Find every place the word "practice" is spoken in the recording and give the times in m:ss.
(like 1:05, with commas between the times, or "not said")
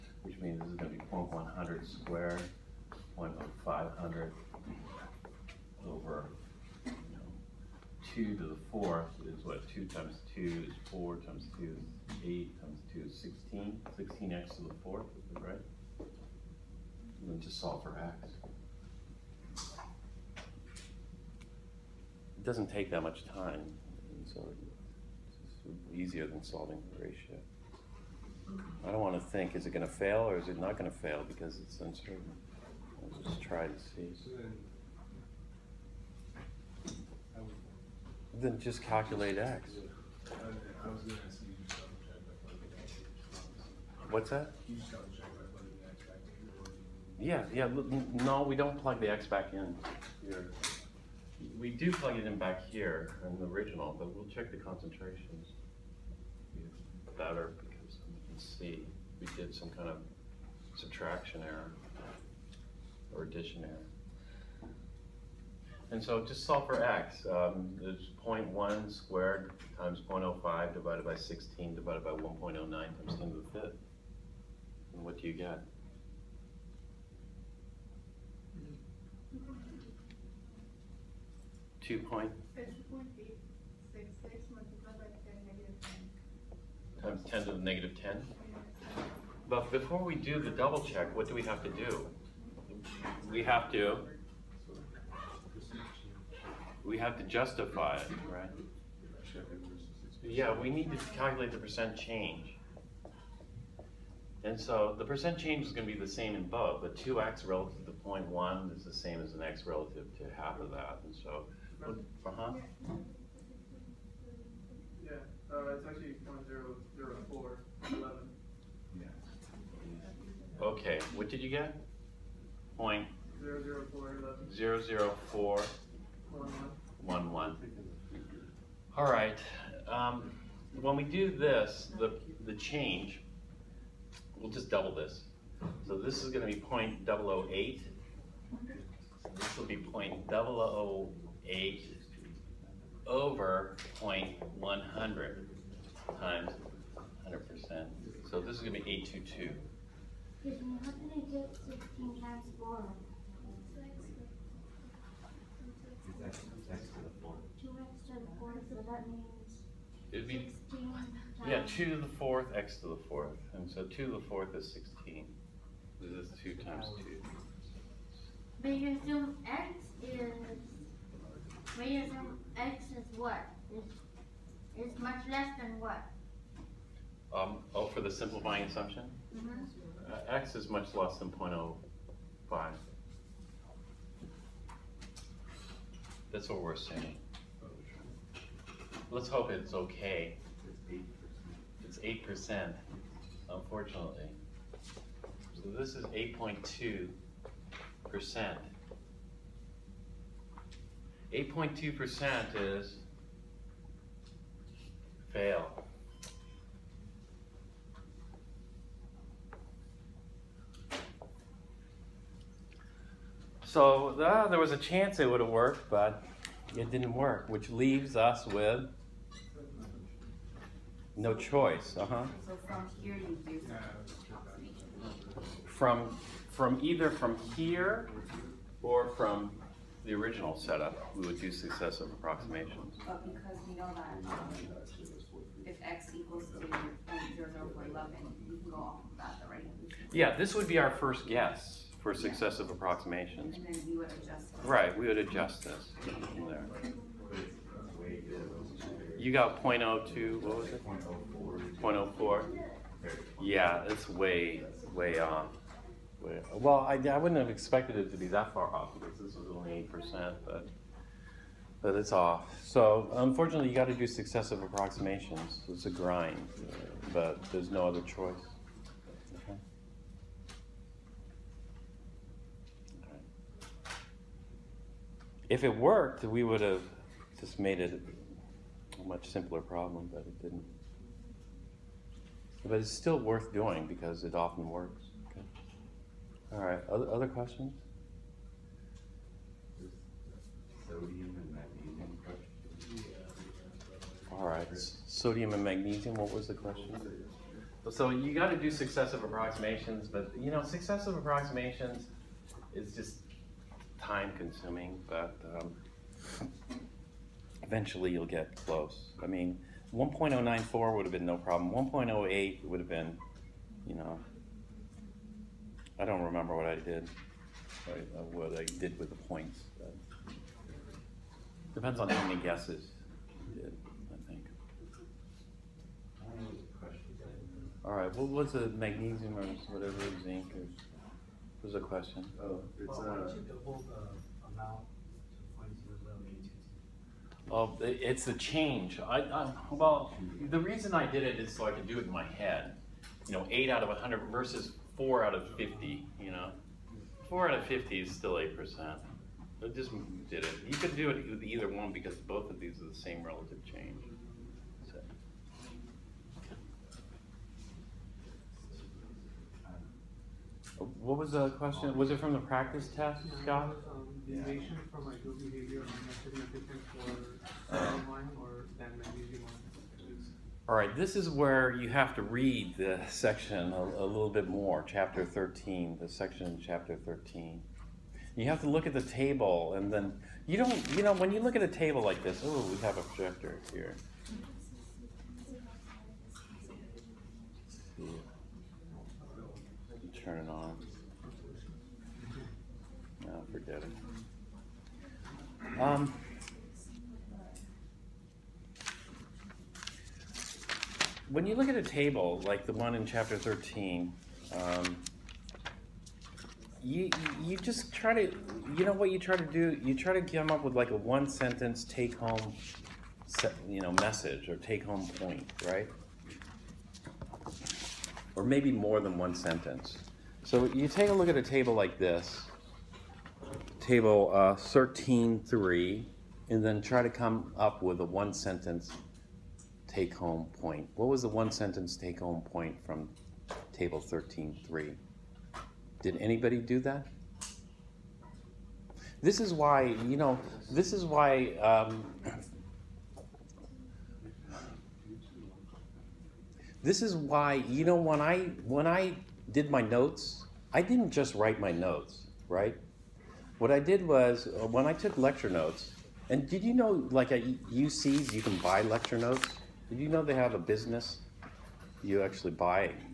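6:02.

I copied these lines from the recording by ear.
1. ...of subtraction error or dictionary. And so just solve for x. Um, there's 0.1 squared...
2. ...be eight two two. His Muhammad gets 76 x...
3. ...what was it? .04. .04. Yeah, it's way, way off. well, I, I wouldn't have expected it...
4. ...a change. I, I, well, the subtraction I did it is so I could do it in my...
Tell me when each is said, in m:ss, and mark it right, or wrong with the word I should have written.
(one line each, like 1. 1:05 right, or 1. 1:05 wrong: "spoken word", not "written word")
1. 0:59 right
2. 2:28 wrong: "16", not "76"
3. 4:10 right
4. 5:38 wrong: "reason", not "subtraction".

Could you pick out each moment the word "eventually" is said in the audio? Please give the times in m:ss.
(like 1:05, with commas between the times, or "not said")
5:07.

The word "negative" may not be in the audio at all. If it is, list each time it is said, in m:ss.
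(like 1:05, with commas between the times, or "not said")
1:27.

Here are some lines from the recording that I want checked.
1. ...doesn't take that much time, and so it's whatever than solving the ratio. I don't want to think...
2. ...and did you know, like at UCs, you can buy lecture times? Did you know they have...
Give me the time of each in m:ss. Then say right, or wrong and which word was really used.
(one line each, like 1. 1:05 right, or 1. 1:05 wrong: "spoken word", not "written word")
1. 0:22 wrong: "easier", not "whatever"
2. 7:36 wrong: "notes", not "times".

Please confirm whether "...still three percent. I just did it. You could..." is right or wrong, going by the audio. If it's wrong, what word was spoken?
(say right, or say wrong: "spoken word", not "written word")
wrong: "eight", not "three".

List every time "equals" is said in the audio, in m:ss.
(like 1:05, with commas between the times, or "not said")
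3:56.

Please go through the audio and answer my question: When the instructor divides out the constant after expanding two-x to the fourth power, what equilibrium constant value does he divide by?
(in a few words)
1.09 x 10^5.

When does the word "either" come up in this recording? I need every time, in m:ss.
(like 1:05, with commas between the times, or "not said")
3:46, 5:51.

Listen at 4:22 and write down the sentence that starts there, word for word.
So unfortunately, you got to do successive approximations.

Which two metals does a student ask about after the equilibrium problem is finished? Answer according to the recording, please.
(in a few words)
sodium and magnesium.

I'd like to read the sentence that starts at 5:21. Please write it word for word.
Depends on how many guesses you did, I think.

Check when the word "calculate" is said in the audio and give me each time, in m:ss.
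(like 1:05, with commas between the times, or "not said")
0:38, 1:41.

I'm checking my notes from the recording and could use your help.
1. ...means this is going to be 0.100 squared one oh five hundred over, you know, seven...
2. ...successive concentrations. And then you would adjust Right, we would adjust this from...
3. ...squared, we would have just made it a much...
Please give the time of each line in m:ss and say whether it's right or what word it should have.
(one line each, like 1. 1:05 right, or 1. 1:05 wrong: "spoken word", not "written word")
1. 0:00 wrong: "two", not "seven"
2. 4:02 wrong: "approximations", not "concentrations"
3. 4:35 wrong: "worked", not "squared".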